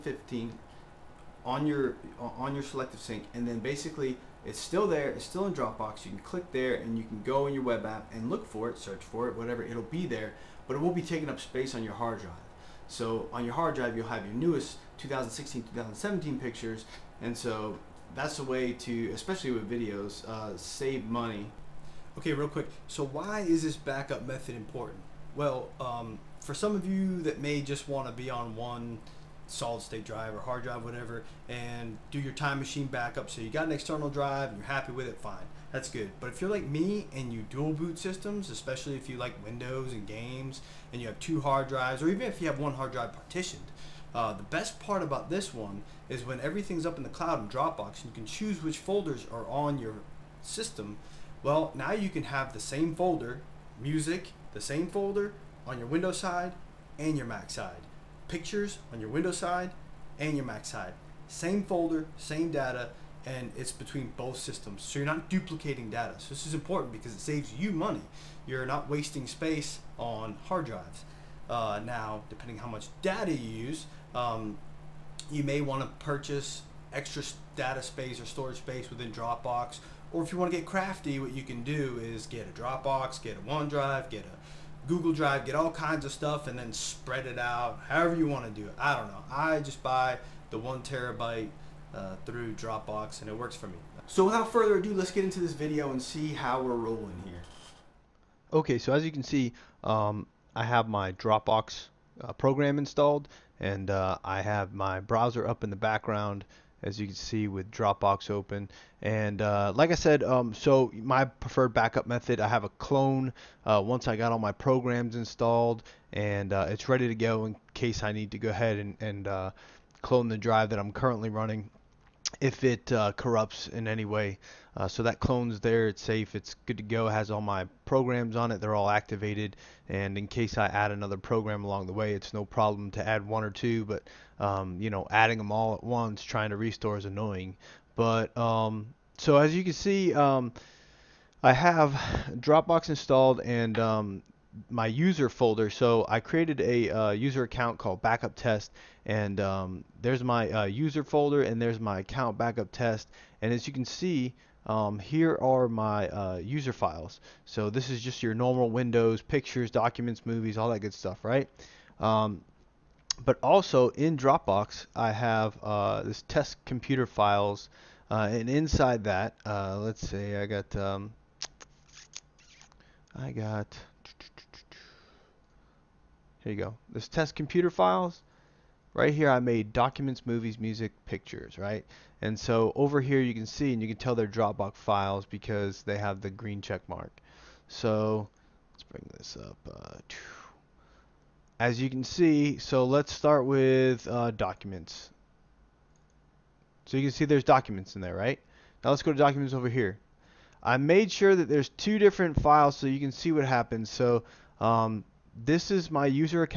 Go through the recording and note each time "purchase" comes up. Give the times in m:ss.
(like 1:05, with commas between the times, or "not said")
1:16.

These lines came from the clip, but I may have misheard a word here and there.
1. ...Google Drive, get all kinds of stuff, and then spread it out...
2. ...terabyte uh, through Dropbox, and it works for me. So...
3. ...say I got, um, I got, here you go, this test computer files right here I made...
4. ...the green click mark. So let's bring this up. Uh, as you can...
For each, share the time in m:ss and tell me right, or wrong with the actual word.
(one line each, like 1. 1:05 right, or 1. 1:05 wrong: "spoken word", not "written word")
1. 1:24 right
2. 1:30 right
3. 2:50 right
4. 3:06 wrong: "check", not "click".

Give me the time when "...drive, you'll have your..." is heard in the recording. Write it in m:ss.
0:13.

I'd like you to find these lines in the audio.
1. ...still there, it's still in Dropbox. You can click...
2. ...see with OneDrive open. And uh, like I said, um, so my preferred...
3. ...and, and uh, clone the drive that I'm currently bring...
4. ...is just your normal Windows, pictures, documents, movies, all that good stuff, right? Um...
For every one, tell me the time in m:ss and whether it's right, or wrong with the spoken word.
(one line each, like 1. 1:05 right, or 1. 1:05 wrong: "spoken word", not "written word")
1. 0:04 right
2. 1:47 wrong: "Dropbox", not "OneDrive"
3. 1:58 wrong: "running", not "bring"
4. 2:37 right.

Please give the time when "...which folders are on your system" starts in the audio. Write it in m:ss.
0:48.